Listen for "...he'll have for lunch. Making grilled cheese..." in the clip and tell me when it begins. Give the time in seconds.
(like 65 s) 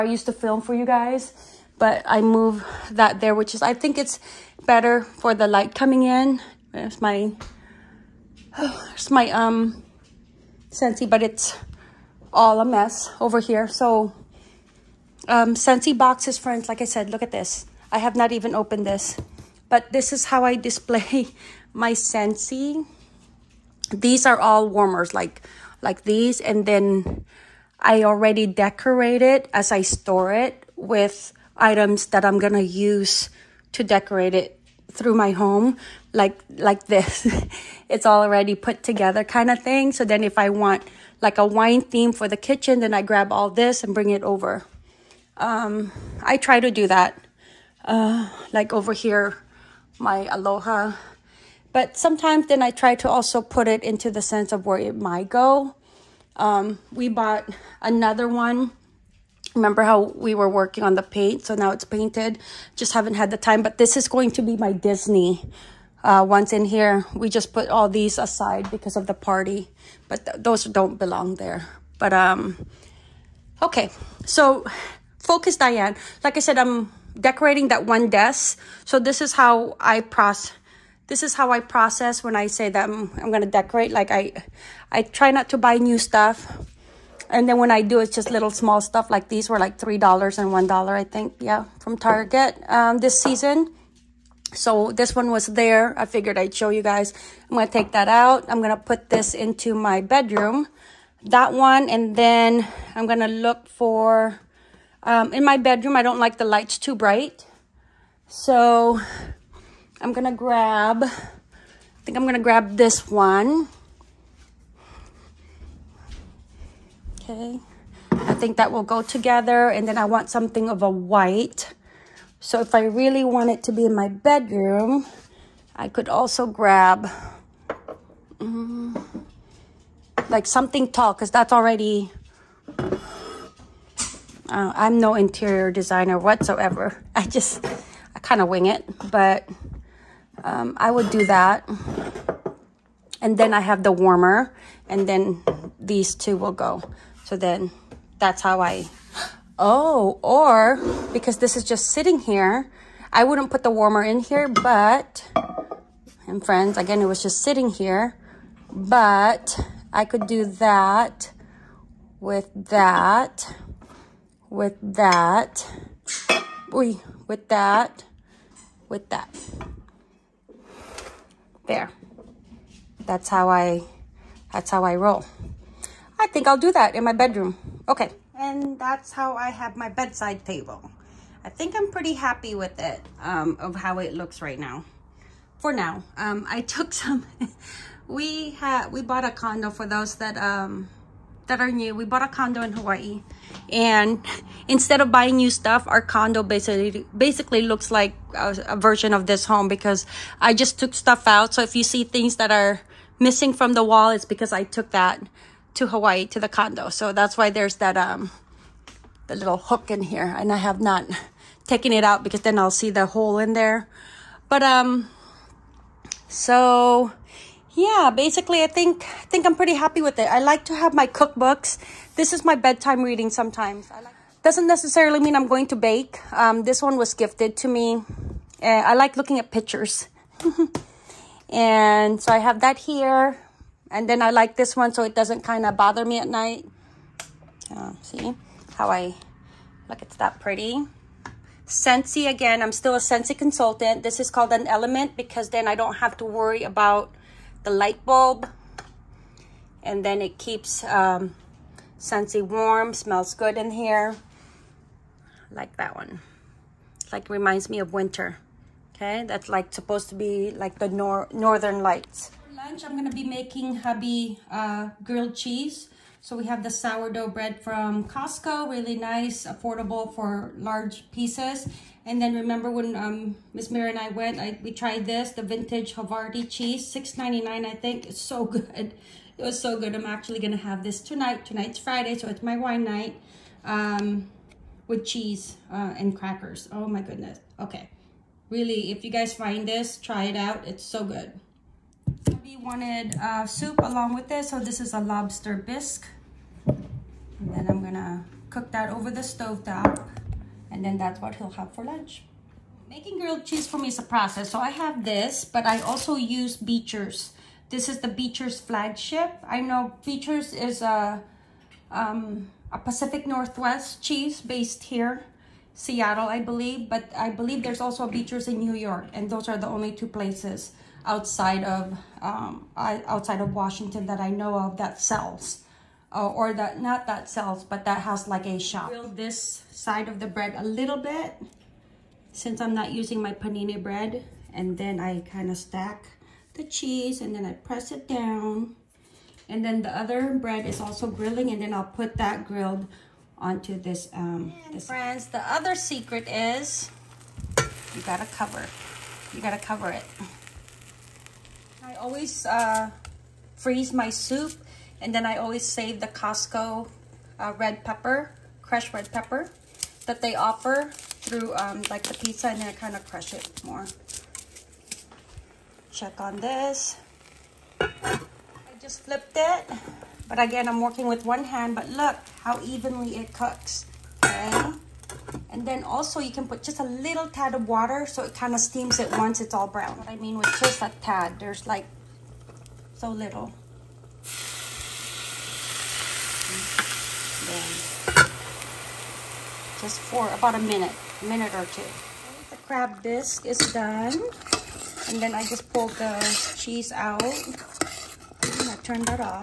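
301 s.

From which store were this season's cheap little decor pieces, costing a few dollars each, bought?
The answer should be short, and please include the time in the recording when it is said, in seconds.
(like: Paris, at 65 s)
Target, at 91 s.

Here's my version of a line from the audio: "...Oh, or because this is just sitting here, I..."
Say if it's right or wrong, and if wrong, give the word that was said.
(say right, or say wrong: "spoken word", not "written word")
right.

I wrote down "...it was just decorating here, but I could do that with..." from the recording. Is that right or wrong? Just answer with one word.
wrong.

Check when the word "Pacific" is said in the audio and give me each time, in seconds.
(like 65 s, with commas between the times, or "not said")
312 s.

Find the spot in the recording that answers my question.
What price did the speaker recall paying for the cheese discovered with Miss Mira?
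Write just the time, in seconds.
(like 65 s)
276 s.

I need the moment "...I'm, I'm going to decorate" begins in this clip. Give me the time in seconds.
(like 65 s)
82 s.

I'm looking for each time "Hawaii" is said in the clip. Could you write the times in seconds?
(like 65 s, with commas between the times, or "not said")
192 s, 205 s.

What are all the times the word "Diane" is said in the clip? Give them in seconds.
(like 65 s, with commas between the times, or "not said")
75 s.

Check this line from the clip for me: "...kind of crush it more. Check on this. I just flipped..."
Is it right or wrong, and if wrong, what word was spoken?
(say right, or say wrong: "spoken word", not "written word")
right.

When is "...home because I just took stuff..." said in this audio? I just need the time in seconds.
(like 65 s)
199 s.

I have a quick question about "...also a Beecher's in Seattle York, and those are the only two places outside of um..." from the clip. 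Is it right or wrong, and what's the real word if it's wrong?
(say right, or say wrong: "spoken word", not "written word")
wrong: "New", not "Seattle".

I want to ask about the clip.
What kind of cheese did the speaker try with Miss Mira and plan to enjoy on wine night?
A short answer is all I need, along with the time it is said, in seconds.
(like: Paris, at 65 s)
vintage Havarti, at 275 s.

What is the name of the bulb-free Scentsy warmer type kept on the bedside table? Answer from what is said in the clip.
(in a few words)
element.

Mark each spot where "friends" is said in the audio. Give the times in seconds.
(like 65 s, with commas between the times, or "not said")
16 s, 156 s, 344 s.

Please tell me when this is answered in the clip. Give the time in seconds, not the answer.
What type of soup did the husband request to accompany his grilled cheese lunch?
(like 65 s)
294 s.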